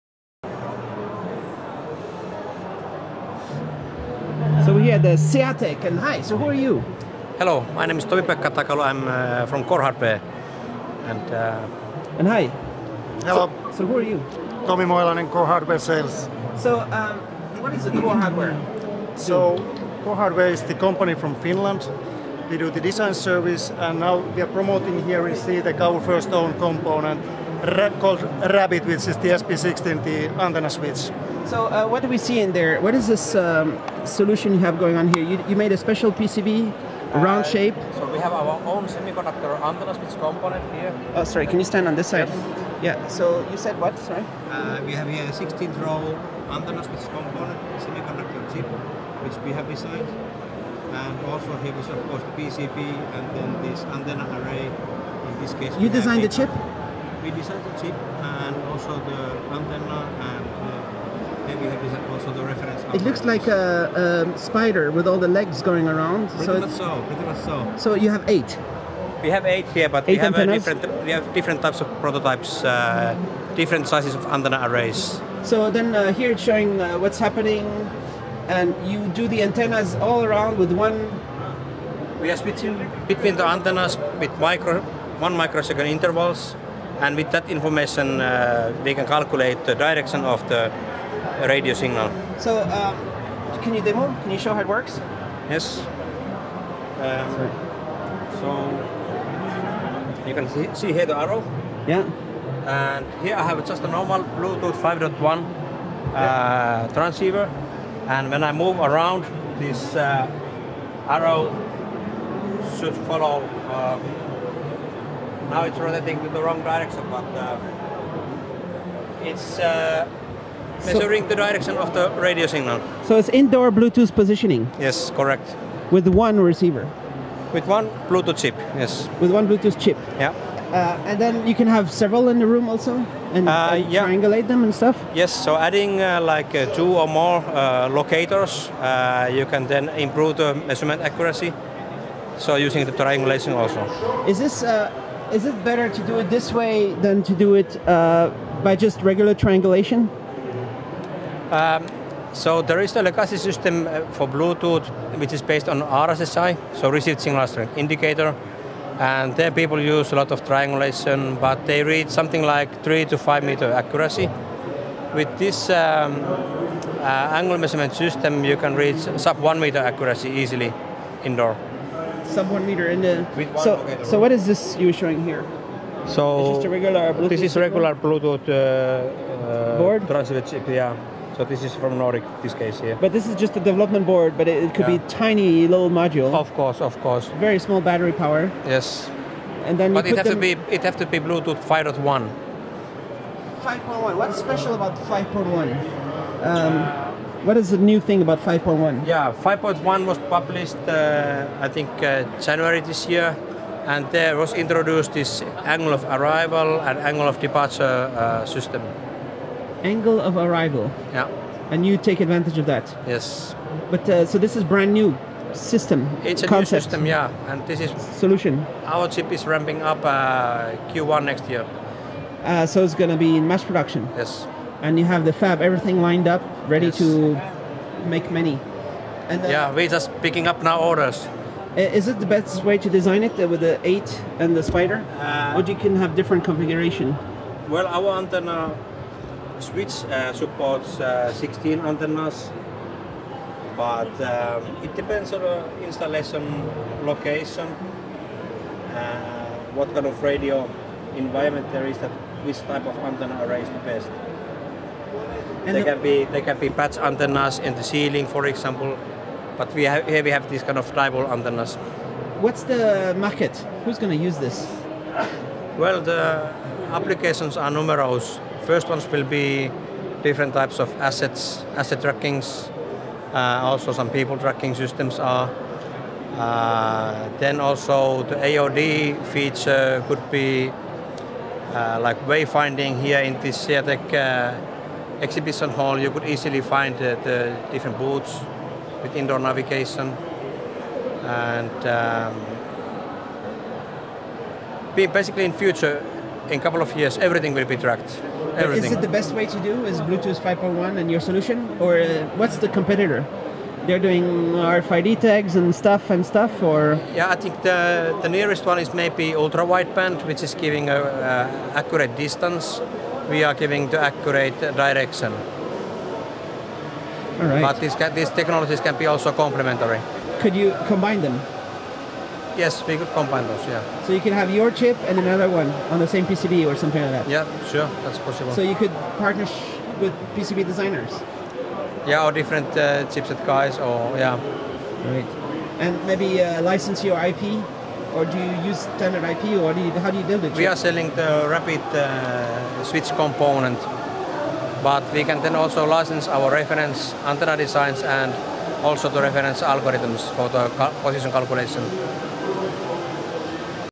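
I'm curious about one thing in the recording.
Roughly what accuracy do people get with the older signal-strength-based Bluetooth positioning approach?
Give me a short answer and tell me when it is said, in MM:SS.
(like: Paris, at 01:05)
3 to 5 meters, at 02:42.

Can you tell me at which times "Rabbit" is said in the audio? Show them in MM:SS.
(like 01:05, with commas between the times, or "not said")
00:28, 05:41.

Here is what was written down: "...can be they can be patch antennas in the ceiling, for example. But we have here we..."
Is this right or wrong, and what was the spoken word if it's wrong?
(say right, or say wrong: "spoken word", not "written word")
right.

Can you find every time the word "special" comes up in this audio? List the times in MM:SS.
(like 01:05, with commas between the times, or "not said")
00:35, 03:14.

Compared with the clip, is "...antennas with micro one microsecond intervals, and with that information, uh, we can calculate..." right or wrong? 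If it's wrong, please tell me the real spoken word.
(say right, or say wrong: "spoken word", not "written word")
right.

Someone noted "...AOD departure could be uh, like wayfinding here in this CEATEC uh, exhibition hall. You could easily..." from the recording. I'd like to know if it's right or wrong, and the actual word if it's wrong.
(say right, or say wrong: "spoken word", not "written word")
wrong: "feature", not "departure".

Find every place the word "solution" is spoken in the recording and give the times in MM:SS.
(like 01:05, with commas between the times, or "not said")
00:34, 03:38, 05:01.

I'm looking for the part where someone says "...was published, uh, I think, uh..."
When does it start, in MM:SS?
03:20.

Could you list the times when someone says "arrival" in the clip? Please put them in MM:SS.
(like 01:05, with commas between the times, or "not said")
03:26, 03:30.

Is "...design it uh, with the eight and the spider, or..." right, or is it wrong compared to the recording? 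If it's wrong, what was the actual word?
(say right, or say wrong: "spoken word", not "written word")
right.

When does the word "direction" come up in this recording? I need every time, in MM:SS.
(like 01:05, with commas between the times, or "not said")
01:29, 01:56, 02:01, 05:14.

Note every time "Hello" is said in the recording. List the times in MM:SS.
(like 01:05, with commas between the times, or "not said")
00:07, 00:13.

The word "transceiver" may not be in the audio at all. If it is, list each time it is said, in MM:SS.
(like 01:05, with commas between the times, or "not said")
01:46, 03:00.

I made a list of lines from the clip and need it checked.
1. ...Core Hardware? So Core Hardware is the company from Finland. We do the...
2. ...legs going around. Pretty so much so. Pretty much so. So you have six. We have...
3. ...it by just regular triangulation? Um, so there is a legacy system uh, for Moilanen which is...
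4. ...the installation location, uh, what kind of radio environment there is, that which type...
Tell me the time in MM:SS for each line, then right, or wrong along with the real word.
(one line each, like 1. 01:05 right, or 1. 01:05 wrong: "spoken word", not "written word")
1. 00:17 right
2. 01:05 wrong: "eight", not "six"
3. 02:27 wrong: "Bluetooth", not "Moilanen"
4. 04:05 right.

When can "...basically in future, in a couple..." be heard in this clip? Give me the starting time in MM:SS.
04:54.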